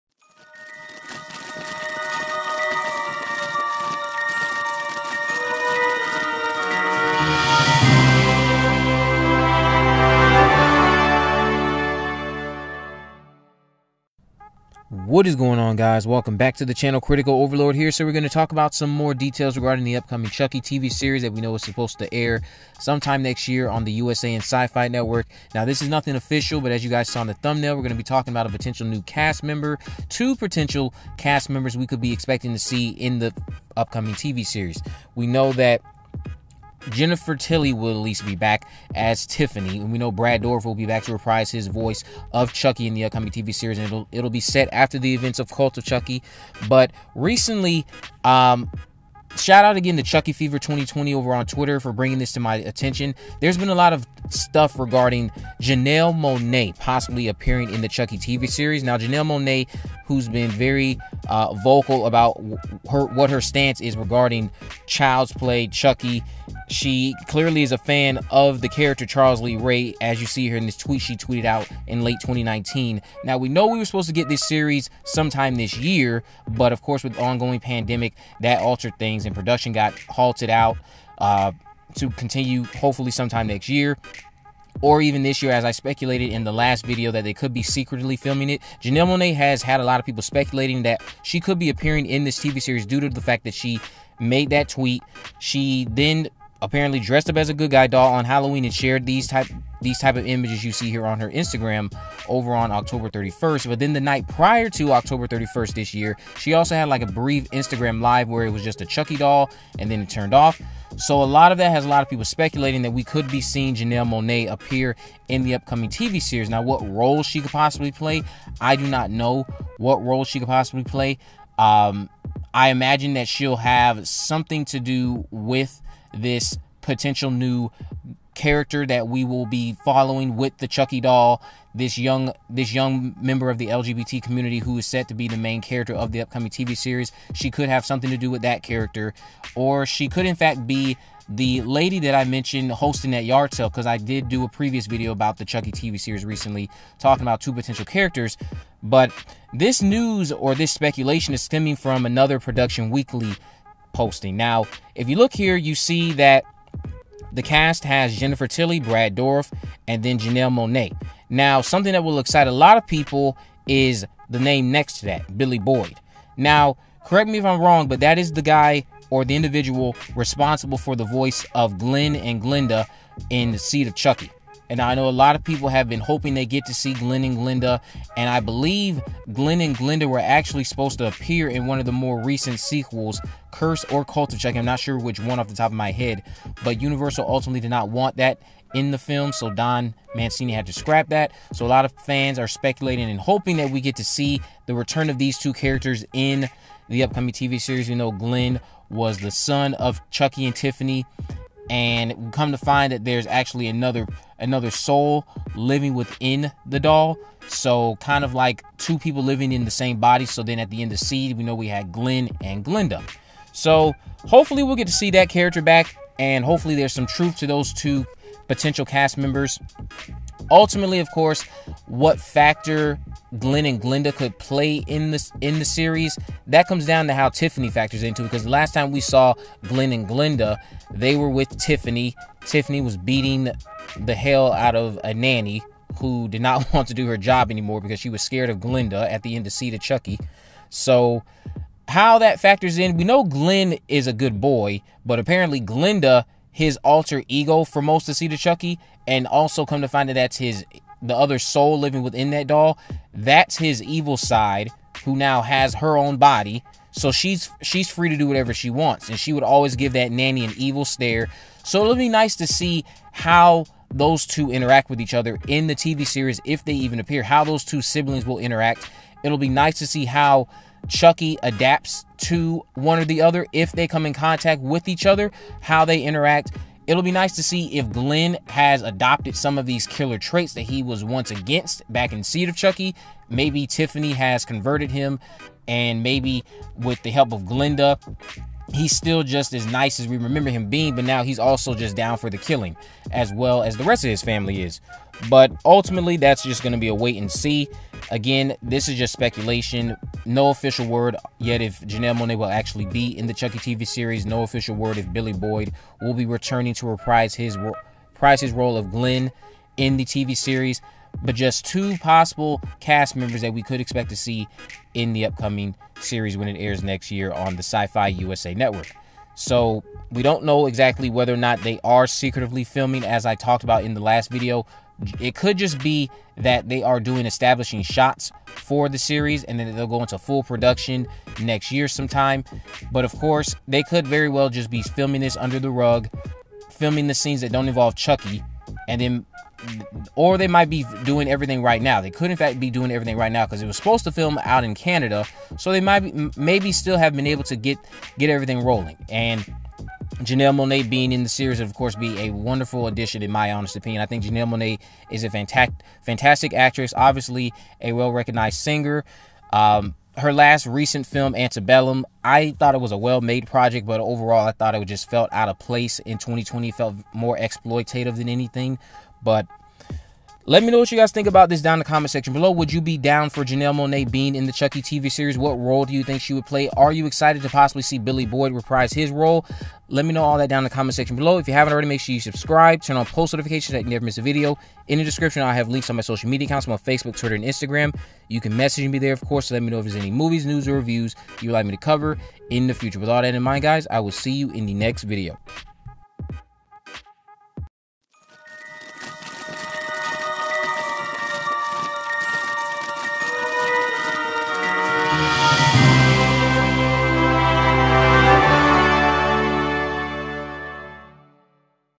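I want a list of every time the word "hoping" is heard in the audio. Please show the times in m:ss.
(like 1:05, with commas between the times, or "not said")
2:55, 3:13.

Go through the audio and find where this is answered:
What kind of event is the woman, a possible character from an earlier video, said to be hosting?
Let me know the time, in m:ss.
2:23.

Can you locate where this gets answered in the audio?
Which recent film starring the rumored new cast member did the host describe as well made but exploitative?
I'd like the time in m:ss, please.
6:01.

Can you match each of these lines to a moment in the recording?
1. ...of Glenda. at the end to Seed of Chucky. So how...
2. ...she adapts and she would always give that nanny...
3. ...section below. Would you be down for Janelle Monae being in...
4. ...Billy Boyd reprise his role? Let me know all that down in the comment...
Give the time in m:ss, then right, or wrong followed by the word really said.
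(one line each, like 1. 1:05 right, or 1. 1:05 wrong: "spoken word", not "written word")
1. 3:58 right
2. 4:18 wrong: "wants", not "adapts"
3. 6:12 right
4. 6:17 right.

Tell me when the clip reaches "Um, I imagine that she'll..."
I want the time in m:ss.
2:01.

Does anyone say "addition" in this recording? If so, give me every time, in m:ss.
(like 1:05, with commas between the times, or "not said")
5:52.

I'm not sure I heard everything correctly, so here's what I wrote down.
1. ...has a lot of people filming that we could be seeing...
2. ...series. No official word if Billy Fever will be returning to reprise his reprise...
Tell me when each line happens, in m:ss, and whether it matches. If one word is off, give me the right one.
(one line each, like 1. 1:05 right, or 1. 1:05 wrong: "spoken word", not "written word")
1. 1:51 wrong: "speculating", not "filming"
2. 5:03 wrong: "Boyd", not "Fever".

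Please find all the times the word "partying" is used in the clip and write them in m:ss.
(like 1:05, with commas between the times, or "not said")
not said.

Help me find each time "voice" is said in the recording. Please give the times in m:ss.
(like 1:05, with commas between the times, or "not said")
0:41, 2:51.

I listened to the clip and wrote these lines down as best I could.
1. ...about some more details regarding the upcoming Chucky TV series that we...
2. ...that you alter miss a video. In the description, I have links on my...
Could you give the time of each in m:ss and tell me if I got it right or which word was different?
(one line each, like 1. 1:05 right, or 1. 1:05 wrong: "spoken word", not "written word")
1. 0:18 right
2. 6:23 wrong: "never", not "alter".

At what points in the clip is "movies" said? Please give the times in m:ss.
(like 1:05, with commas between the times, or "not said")
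6:30.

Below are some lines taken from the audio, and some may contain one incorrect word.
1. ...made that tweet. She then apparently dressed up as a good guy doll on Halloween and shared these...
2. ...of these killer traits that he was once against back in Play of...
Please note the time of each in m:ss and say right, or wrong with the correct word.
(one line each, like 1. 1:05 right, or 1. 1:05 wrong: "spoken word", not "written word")
1. 1:34 right
2. 4:39 wrong: "Seed", not "Play".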